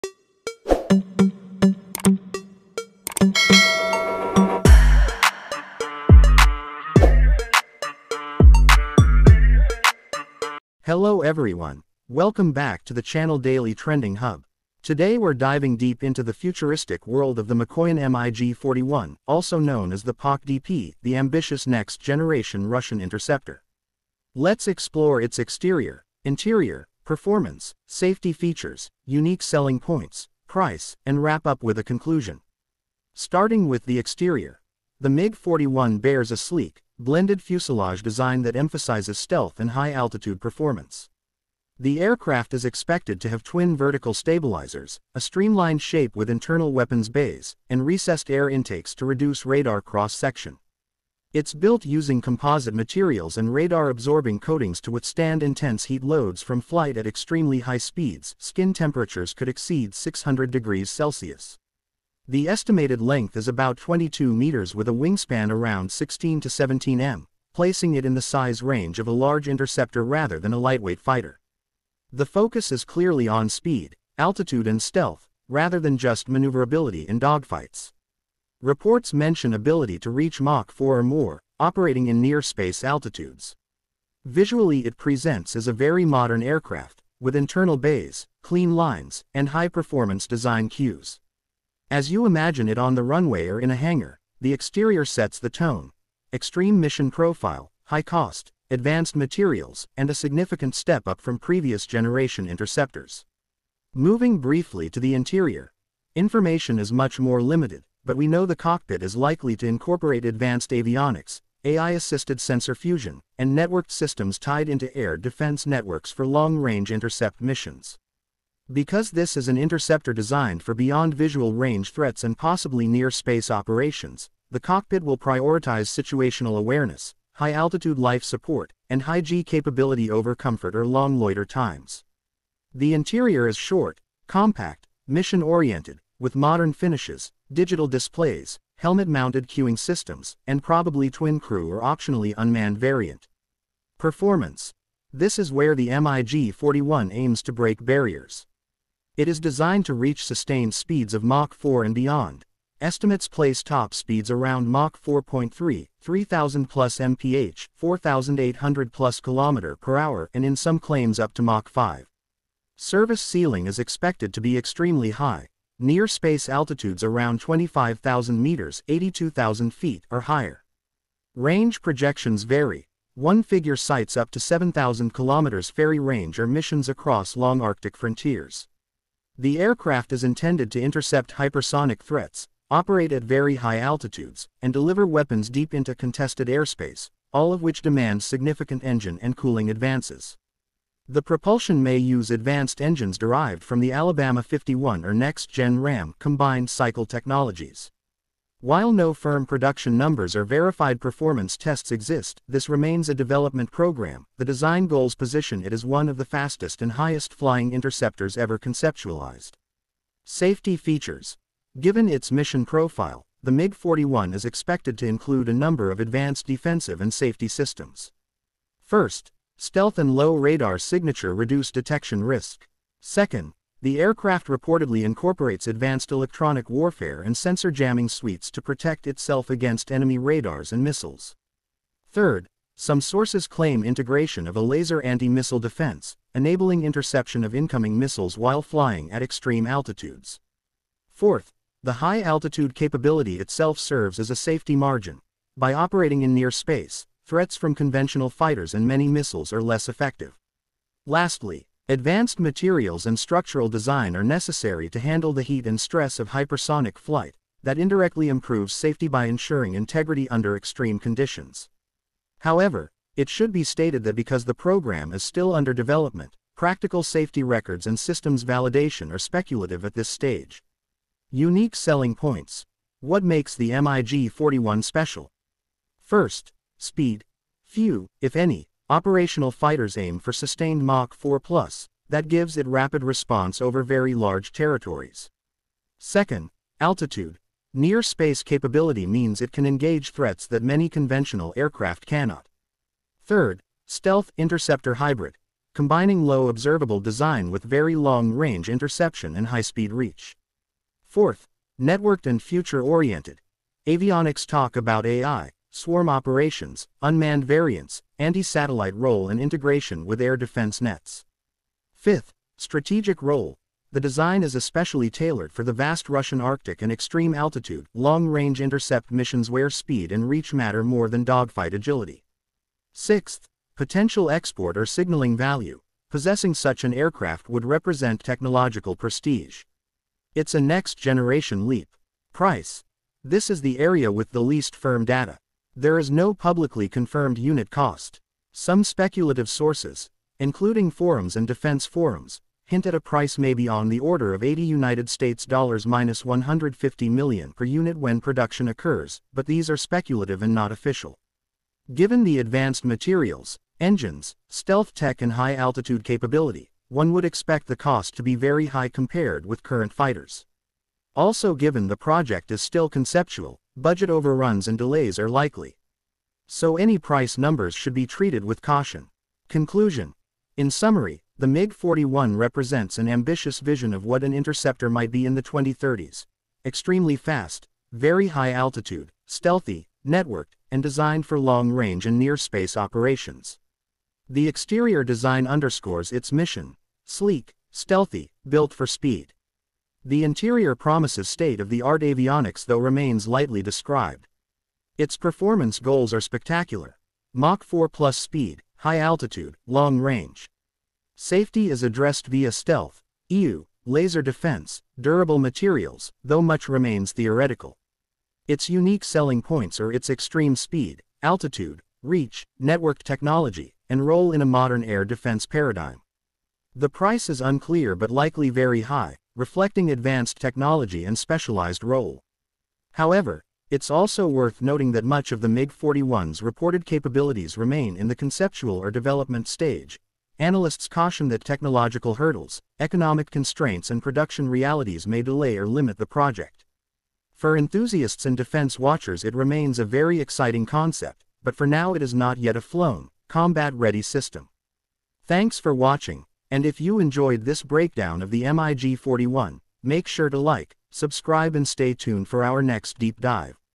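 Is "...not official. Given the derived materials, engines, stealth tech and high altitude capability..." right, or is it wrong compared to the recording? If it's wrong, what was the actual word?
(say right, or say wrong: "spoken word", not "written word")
wrong: "advanced", not "derived".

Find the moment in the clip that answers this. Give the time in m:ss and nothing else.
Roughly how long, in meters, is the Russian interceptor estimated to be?
1:03.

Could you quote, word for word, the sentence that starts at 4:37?
Few, if any, operational fighters aim for sustained Mach 4 plus, that gives it rapid response over very large territories.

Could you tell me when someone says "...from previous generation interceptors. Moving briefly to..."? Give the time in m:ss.
1:41.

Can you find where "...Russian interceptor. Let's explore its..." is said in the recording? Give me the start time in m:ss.
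0:22.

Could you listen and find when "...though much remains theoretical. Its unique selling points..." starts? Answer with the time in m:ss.
6:46.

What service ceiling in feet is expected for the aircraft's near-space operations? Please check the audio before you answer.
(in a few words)
82,000 feet.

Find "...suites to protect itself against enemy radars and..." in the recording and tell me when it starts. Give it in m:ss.
3:48.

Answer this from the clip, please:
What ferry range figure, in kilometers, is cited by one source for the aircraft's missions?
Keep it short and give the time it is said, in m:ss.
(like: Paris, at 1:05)
7,000 kilometers, at 2:54.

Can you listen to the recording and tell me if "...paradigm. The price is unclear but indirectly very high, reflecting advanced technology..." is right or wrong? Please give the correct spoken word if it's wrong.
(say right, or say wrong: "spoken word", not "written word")
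wrong: "likely", not "indirectly".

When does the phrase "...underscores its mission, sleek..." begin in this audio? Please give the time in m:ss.
6:25.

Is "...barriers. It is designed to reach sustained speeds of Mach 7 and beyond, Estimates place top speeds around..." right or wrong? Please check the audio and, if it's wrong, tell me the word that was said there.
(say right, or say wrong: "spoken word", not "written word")
wrong: "4", not "7".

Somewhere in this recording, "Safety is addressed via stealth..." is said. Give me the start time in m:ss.
6:41.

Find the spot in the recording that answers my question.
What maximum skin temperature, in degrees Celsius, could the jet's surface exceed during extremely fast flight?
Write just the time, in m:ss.
0:59.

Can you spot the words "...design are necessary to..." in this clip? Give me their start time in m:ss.
4:13.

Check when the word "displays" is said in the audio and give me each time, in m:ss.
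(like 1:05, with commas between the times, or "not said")
2:17.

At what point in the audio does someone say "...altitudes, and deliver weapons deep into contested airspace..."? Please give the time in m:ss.
3:03.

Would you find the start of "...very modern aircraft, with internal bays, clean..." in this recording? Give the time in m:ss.
1:25.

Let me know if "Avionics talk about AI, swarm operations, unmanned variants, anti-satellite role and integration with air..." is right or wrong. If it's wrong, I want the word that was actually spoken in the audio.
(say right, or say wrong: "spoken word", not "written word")
right.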